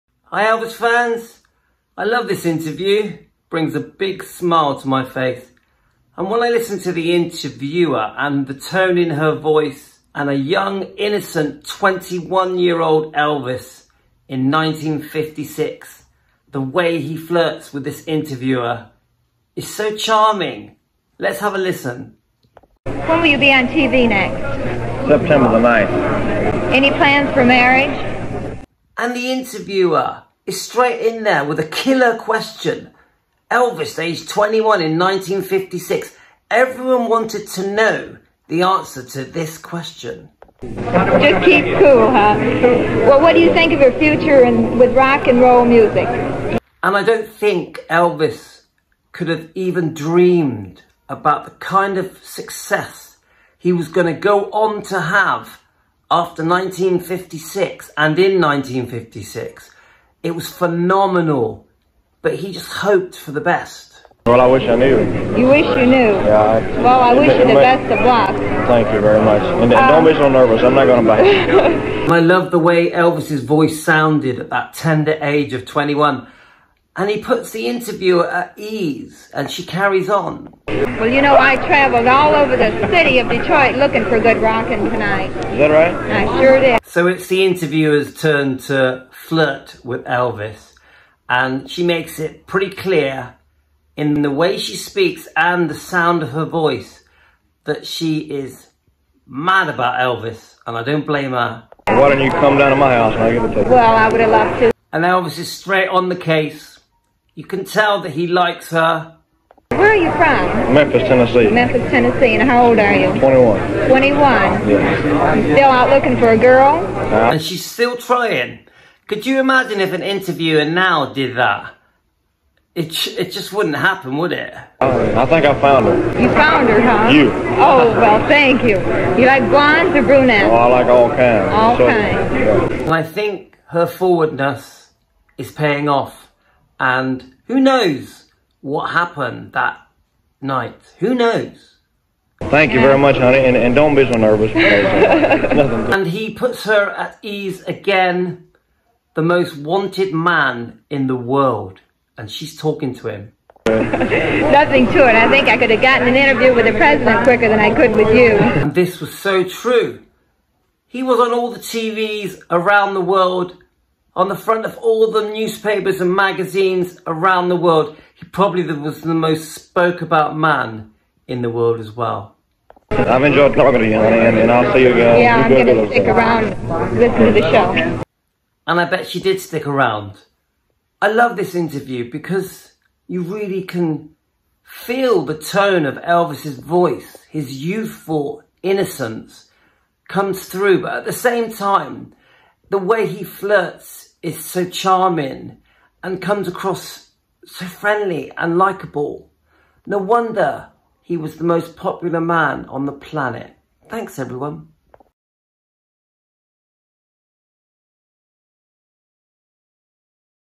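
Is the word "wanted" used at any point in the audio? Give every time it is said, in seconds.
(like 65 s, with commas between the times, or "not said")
37 s, 149 s.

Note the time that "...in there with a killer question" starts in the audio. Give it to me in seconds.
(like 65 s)
31 s.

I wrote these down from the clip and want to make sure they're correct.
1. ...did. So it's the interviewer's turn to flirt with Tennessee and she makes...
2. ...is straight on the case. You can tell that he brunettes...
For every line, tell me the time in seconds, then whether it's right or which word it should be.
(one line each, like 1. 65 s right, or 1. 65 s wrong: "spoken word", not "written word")
1. 86 s wrong: "Elvis", not "Tennessee"
2. 105 s wrong: "likes", not "brunettes".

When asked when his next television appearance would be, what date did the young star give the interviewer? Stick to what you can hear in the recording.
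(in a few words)
September 9.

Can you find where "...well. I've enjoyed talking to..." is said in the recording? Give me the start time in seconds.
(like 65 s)
171 s.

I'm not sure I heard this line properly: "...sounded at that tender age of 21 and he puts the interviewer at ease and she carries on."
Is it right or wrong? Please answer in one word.
right.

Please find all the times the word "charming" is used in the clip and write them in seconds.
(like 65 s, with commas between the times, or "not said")
19 s, 194 s.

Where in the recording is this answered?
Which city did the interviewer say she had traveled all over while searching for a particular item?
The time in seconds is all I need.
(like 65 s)
83 s.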